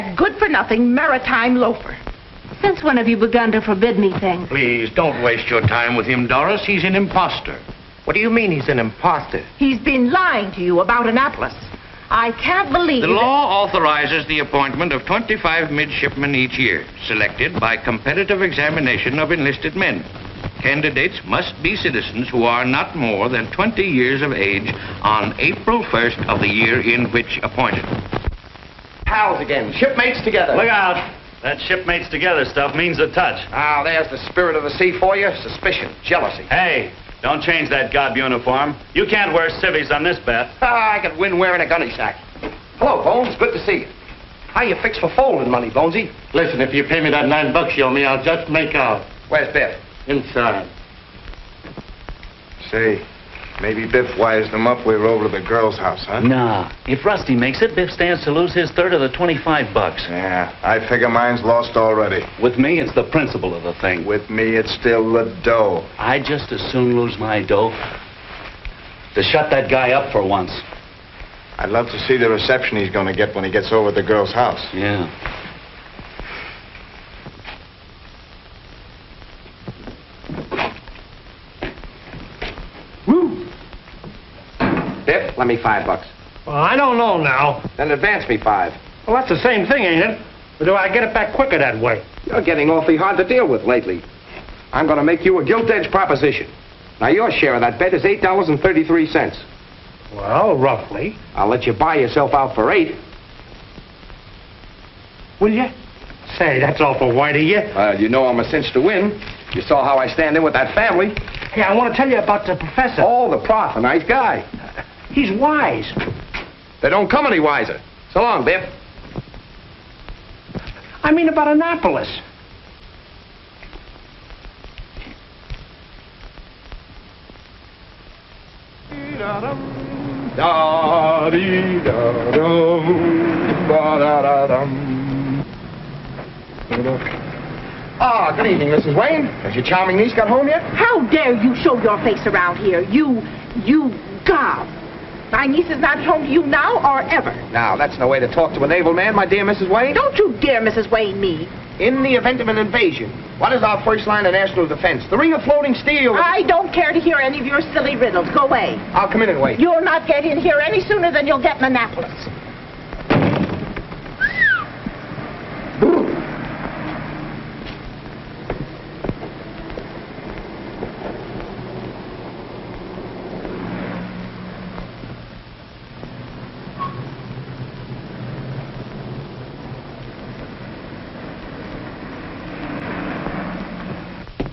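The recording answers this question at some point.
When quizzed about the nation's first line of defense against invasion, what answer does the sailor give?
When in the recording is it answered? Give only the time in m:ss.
2:35.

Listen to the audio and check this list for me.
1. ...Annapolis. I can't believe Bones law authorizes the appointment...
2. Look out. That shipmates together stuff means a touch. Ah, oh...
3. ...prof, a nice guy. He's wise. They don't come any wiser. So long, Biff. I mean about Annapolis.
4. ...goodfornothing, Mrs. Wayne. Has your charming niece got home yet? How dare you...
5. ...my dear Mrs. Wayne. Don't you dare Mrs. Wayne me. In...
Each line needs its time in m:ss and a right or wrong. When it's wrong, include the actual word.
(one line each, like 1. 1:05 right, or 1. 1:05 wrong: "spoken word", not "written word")
1. 0:11 wrong: "The", not "Bones"
2. 0:30 right
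3. 1:53 right
4. 2:18 wrong: "evening", not "goodfornothing"
5. 2:29 right.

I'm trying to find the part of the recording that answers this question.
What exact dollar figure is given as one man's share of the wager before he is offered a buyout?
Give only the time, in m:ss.
1:38.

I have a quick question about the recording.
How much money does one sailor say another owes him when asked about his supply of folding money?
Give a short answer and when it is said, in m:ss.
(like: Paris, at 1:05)
$9, at 0:47.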